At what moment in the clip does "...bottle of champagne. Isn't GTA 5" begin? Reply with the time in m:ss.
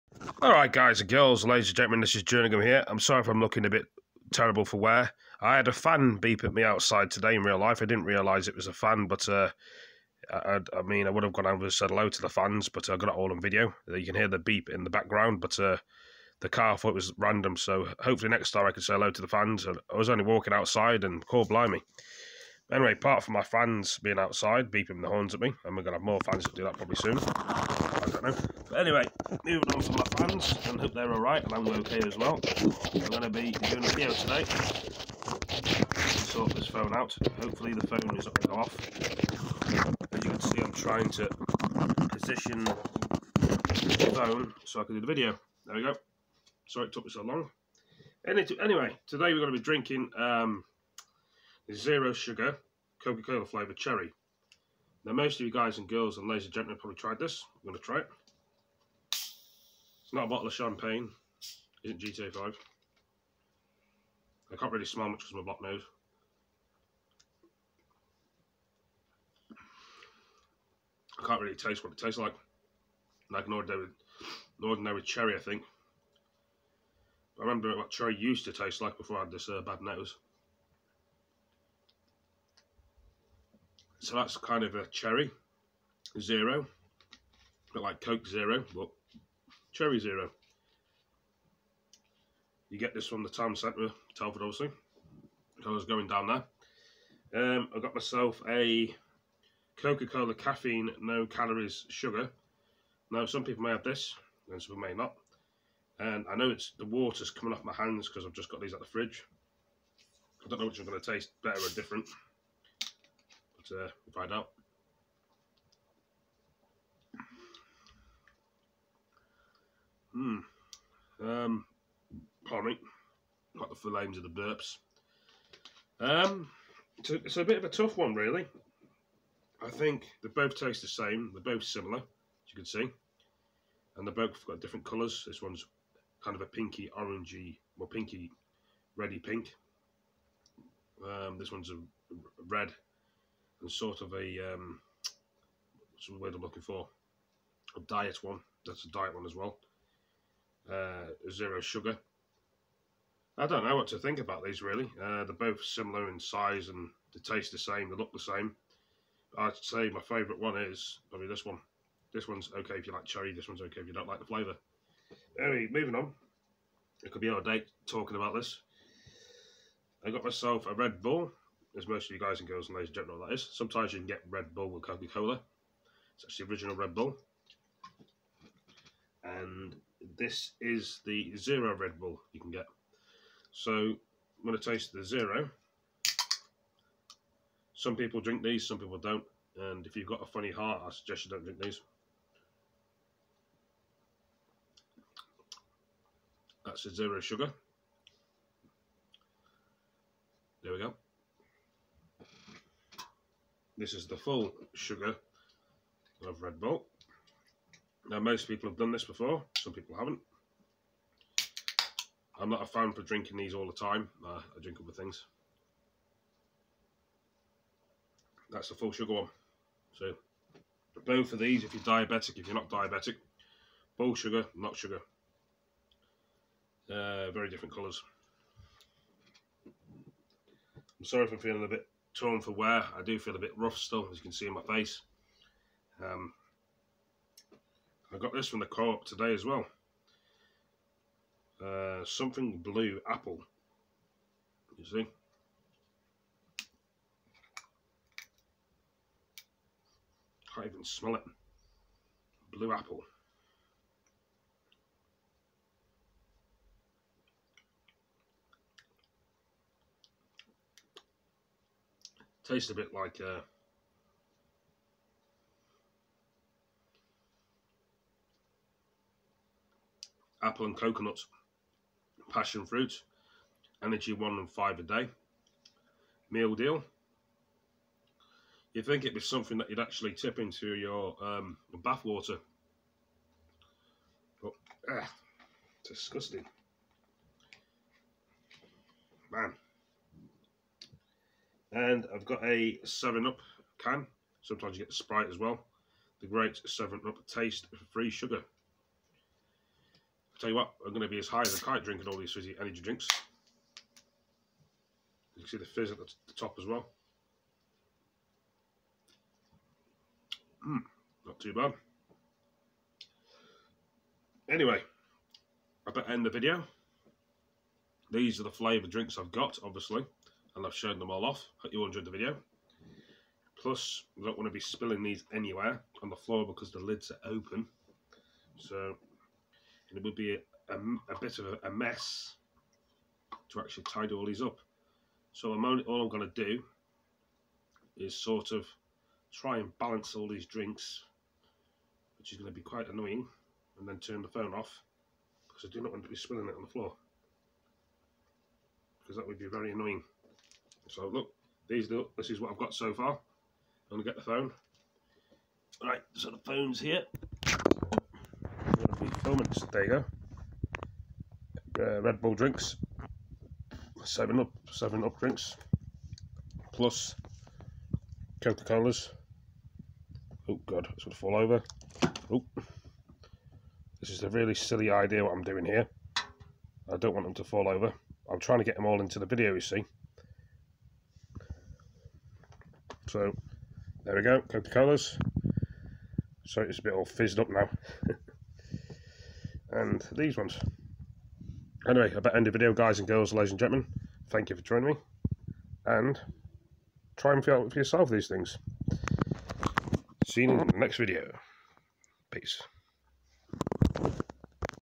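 1:00.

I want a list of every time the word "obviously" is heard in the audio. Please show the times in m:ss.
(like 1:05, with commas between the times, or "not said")
1:34, 5:19.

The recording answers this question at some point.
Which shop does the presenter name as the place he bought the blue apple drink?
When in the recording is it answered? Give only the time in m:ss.
3:58.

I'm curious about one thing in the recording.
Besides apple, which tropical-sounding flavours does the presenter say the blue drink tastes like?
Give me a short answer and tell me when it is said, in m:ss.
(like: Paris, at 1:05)
Coconut, passion fruit, at 4:30.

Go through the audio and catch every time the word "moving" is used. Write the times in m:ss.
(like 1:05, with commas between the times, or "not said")
0:29, 2:45.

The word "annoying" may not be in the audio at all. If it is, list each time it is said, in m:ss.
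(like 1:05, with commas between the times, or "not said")
5:42, 5:49.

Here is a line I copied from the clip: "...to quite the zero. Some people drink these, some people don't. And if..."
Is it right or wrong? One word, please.
wrong.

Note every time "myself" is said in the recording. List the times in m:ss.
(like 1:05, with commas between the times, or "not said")
1:37, 2:50.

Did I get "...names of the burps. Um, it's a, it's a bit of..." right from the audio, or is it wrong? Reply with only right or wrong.
right.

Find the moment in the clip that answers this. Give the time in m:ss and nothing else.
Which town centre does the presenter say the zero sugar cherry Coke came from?
1:34.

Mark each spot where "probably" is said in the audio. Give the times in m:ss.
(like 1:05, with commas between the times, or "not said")
0:26, 0:56, 2:41.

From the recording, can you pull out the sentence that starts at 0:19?
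I was only walking outside, and call blimey.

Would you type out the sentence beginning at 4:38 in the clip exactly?
You think it'd be something that you'd actually tip into your um, bath water, but ah, disgusting, man.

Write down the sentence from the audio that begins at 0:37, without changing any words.
Hopefully the phone is not going to go off.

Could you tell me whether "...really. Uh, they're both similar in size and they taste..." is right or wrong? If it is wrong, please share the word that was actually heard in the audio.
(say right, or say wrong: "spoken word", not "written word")
right.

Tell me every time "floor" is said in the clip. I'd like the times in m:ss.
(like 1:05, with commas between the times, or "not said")
5:26, 5:46.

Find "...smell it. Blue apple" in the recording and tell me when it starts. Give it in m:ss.
4:10.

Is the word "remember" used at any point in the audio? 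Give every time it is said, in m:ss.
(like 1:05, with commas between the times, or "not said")
1:17.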